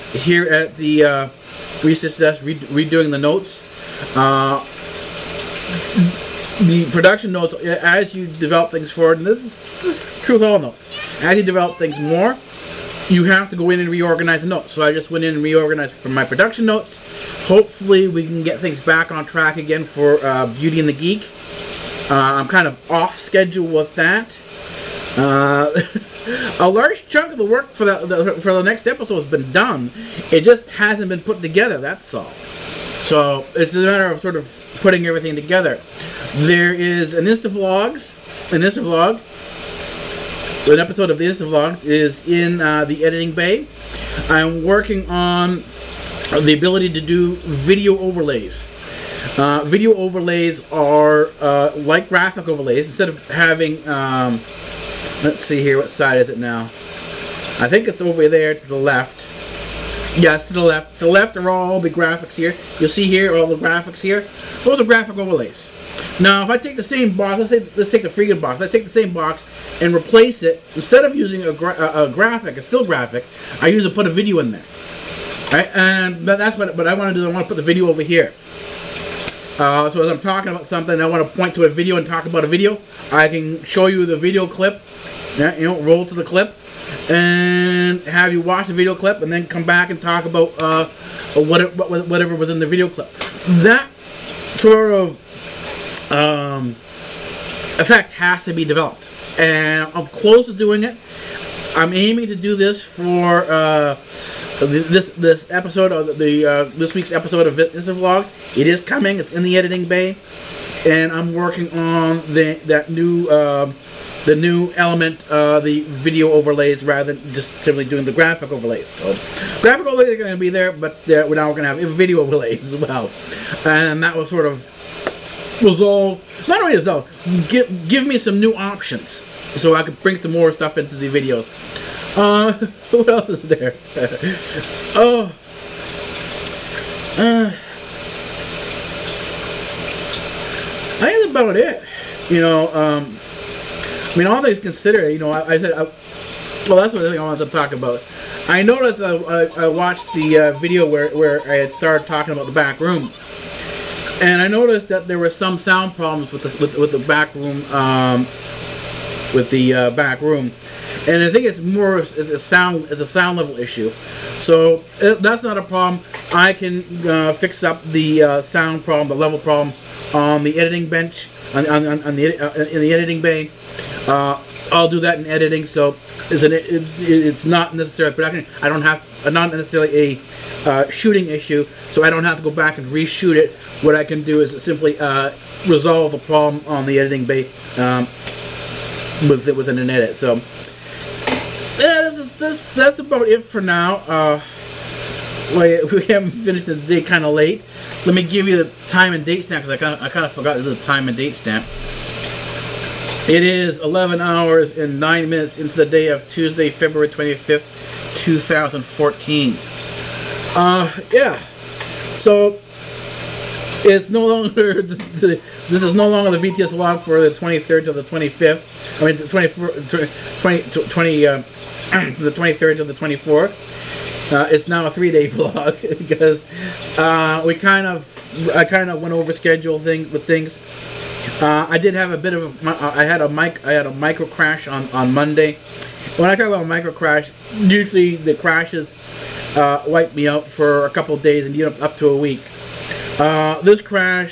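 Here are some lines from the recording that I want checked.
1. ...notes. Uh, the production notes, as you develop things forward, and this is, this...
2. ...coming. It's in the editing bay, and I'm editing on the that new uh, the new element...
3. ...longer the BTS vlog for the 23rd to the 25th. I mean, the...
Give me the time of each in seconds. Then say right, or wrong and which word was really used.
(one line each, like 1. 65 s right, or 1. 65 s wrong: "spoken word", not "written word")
1. 3 s right
2. 108 s wrong: "working", not "editing"
3. 216 s right.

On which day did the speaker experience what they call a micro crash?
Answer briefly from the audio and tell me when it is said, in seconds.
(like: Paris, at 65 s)
Monday, at 235 s.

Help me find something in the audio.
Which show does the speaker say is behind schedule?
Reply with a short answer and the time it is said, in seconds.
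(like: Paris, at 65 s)
Beauty and the Geek, at 20 s.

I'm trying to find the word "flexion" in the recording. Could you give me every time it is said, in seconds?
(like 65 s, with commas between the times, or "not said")
not said.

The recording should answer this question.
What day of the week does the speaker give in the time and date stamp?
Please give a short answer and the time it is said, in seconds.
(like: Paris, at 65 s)
Tuesday, at 206 s.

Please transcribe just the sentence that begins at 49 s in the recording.
Uh, video overlays are uh, like graphic overlays.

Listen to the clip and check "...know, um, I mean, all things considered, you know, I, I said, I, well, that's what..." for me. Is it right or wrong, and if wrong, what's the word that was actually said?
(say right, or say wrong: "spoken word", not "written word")
right.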